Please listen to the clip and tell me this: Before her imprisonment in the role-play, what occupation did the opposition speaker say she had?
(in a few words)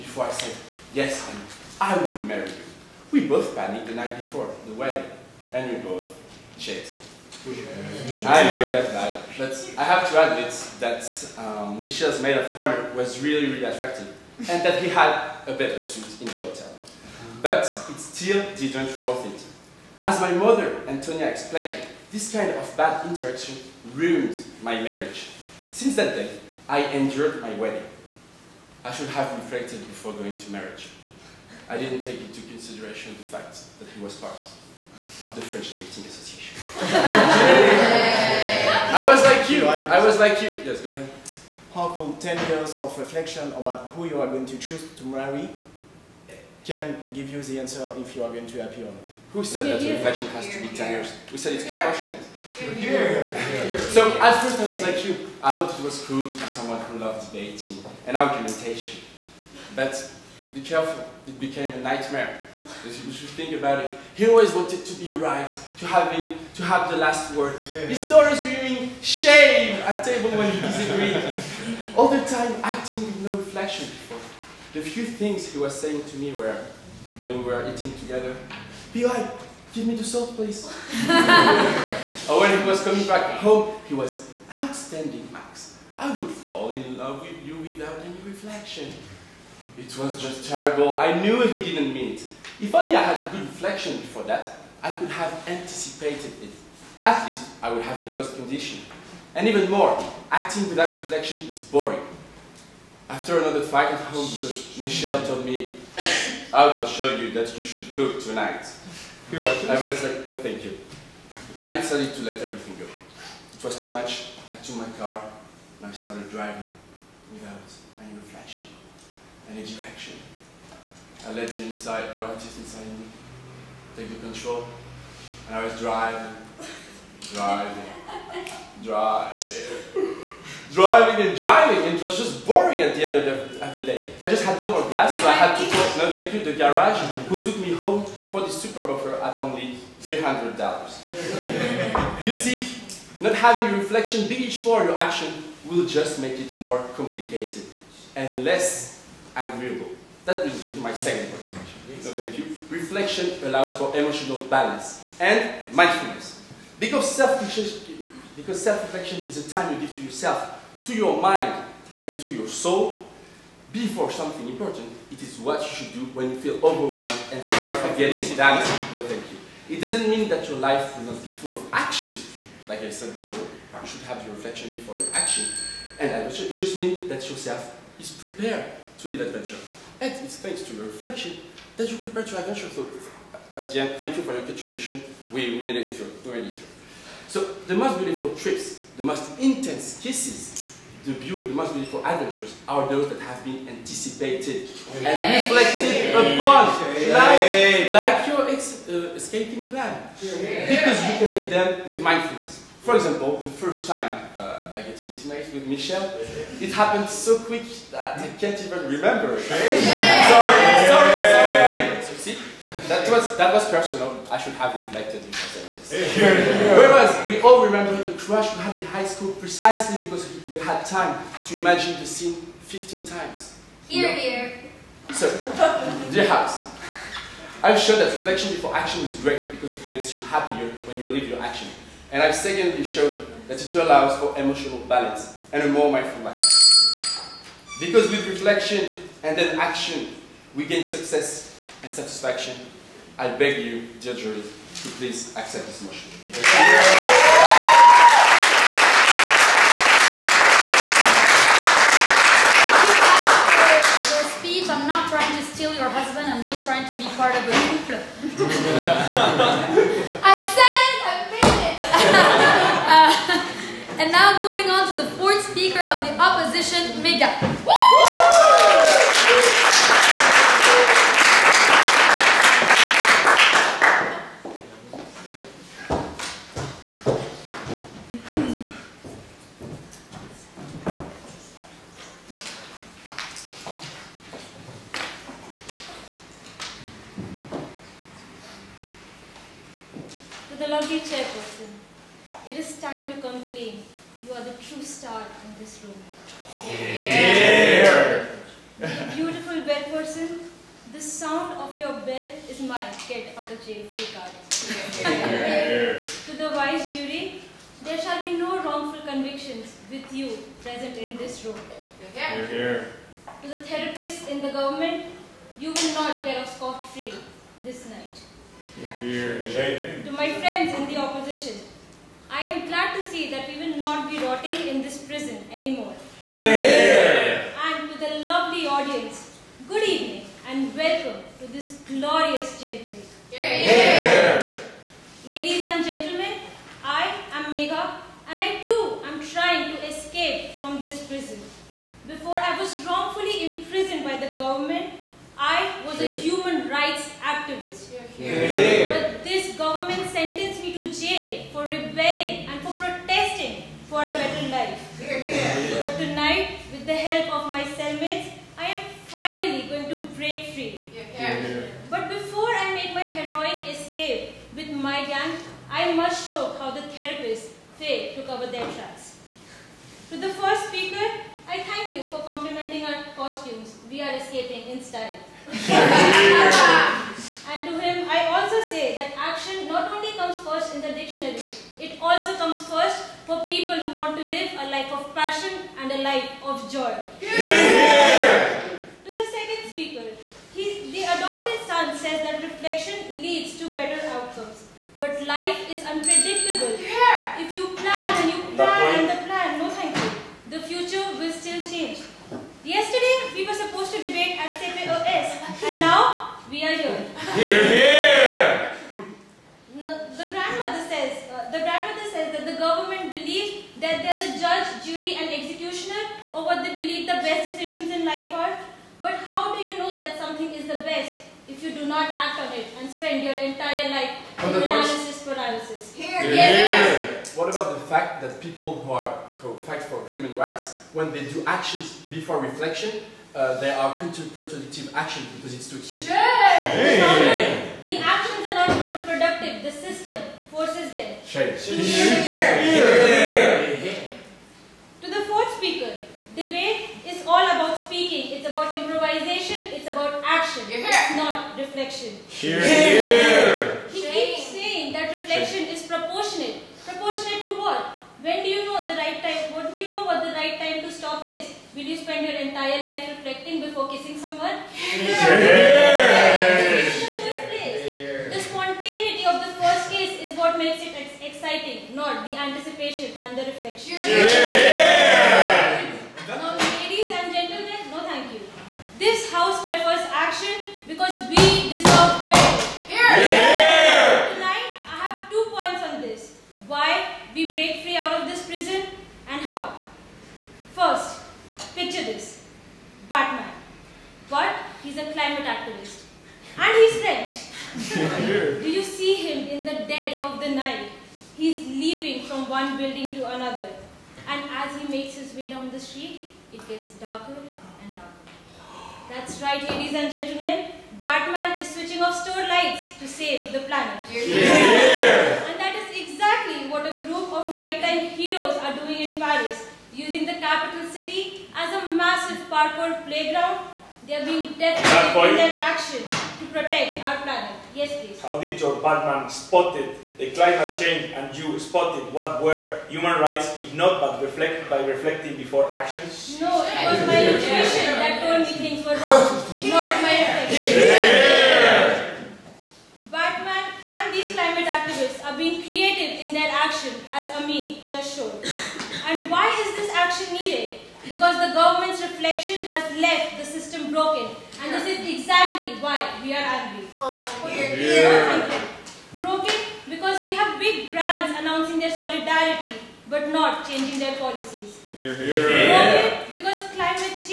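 human rights activist.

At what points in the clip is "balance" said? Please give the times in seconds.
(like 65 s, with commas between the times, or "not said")
154 s, 234 s.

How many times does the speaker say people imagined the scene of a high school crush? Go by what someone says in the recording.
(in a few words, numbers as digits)
15.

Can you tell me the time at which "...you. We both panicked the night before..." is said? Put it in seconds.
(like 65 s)
2 s.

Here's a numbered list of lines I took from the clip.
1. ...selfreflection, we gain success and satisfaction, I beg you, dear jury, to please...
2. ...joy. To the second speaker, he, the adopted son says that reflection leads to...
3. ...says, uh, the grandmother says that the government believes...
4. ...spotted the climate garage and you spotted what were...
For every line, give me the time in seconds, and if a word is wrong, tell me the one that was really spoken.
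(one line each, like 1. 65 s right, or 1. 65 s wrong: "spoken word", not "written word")
1. 239 s wrong: "action", not "selfreflection"
2. 386 s right
3. 410 s right
4. 529 s wrong: "change", not "garage".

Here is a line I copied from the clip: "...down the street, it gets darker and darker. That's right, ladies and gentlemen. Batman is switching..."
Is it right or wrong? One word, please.
right.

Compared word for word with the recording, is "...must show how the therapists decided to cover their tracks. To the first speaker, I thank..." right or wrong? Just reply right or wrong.
wrong.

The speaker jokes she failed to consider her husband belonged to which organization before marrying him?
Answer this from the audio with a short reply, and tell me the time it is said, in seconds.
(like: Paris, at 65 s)
French Dating Association, at 35 s.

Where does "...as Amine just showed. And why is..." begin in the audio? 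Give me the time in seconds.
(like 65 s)
547 s.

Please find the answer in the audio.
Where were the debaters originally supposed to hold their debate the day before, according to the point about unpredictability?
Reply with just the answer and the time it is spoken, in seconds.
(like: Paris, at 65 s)
CPOS, at 404 s.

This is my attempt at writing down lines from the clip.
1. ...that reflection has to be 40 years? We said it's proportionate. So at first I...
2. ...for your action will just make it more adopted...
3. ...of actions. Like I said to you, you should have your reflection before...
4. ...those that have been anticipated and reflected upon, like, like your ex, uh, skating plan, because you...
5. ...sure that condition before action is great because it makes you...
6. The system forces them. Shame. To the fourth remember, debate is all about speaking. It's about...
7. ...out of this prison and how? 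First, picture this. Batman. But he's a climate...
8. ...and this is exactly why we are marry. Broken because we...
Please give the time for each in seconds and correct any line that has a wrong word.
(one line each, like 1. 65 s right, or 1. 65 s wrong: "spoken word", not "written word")
1. 49 s wrong: "10", not "40"
2. 144 s wrong: "complicated", not "adopted"
3. 171 s right
4. 192 s right
5. 227 s wrong: "reflection", not "condition"
6. 439 s wrong: "speaker", not "remember"
7. 487 s right
8. 554 s wrong: "angry", not "marry".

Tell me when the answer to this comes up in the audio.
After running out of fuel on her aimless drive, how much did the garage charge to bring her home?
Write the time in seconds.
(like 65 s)
140 s.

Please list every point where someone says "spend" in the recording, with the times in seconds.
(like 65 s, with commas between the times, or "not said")
422 s, 461 s.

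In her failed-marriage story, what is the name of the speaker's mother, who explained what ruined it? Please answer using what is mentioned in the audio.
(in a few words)
Antonia.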